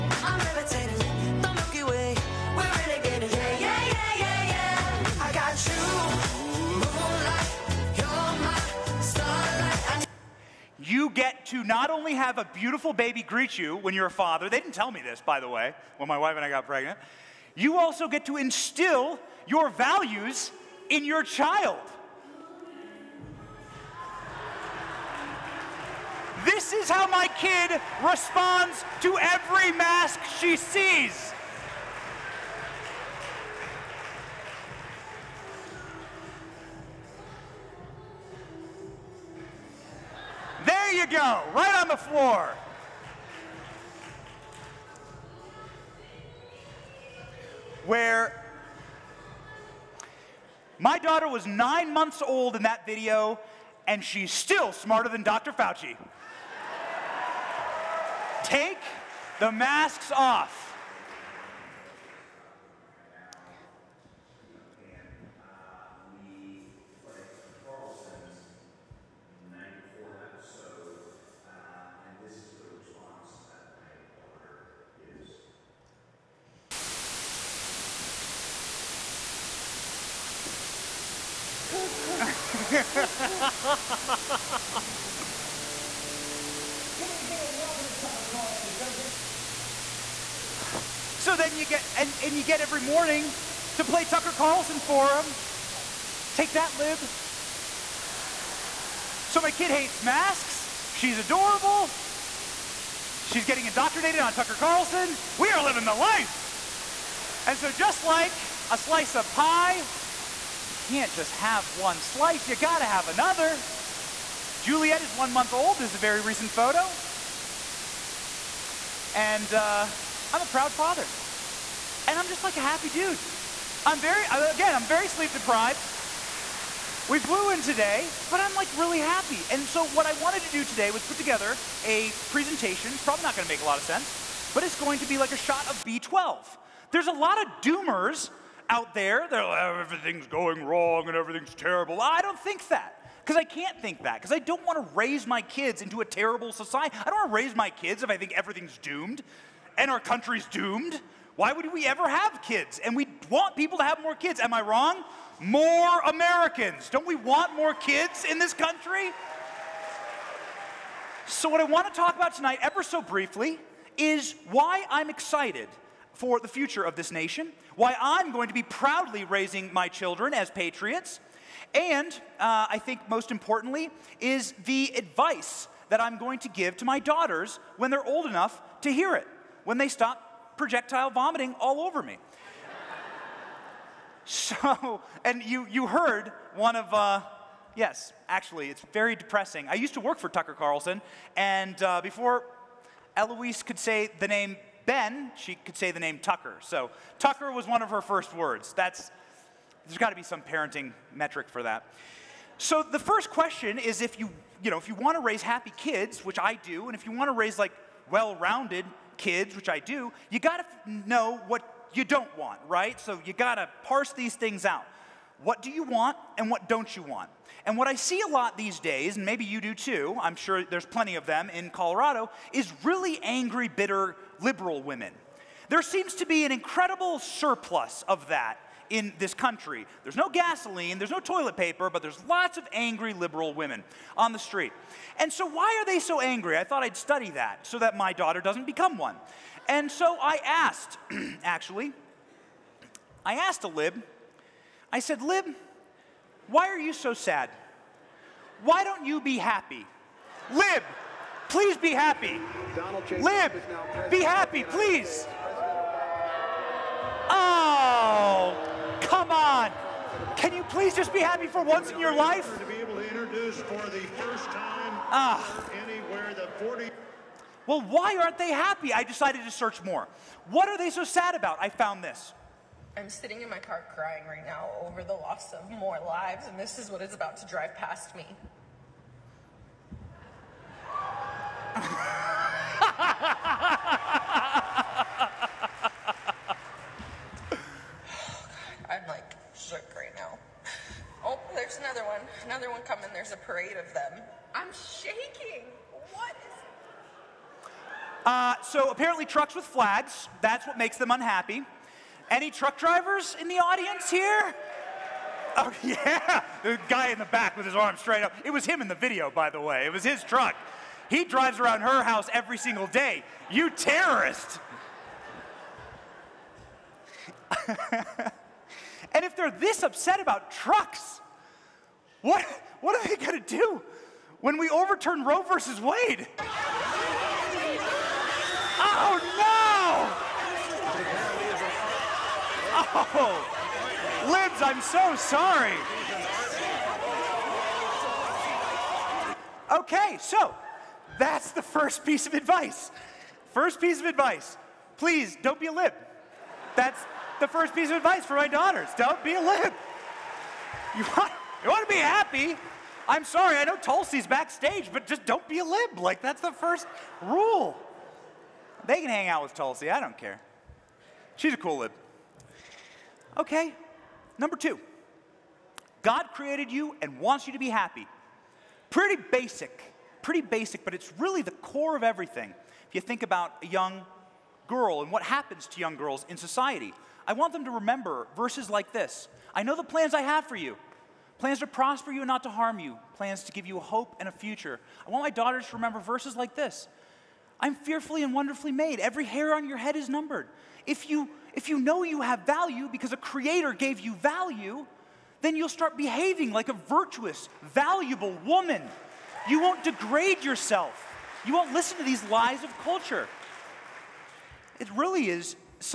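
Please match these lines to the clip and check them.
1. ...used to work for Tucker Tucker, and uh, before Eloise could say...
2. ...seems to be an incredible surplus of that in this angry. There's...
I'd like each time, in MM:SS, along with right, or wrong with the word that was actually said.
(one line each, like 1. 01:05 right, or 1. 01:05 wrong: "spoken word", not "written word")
1. 03:09 wrong: "Carlson", not "Tucker"
2. 03:45 wrong: "country", not "angry".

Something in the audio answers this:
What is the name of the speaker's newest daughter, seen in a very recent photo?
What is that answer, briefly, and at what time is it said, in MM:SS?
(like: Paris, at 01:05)
Juliet, at 01:54.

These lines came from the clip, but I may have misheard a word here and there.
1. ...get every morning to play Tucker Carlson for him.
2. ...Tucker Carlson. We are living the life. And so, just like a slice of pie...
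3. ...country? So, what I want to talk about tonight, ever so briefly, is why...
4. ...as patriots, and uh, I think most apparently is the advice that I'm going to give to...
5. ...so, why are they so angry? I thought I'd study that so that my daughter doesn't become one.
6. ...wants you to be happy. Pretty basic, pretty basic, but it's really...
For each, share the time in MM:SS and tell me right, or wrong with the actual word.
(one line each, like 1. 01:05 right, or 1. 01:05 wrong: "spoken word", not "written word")
1. 01:32 right
2. 01:44 right
3. 02:38 right
4. 02:50 wrong: "importantly", not "apparently"
5. 03:55 right
6. 06:07 right.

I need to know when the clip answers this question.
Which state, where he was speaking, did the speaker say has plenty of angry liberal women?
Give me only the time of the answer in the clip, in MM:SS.
03:41.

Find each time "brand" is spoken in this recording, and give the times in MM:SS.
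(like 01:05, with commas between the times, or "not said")
not said.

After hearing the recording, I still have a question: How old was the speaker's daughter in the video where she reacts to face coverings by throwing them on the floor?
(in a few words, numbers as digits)
9 months.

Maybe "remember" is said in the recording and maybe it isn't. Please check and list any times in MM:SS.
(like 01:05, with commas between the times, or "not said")
06:17, 06:25.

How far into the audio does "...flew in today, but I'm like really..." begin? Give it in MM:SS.
02:07.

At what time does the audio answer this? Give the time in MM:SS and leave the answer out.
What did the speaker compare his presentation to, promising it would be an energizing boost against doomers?
02:15.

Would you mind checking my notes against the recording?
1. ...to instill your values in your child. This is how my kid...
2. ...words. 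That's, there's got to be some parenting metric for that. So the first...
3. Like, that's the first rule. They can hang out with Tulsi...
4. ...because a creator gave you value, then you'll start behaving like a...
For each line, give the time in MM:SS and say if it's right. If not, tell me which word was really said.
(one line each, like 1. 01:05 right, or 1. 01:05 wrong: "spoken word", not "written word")
1. 00:18 right
2. 03:18 right
3. 05:55 right
4. 06:32 right.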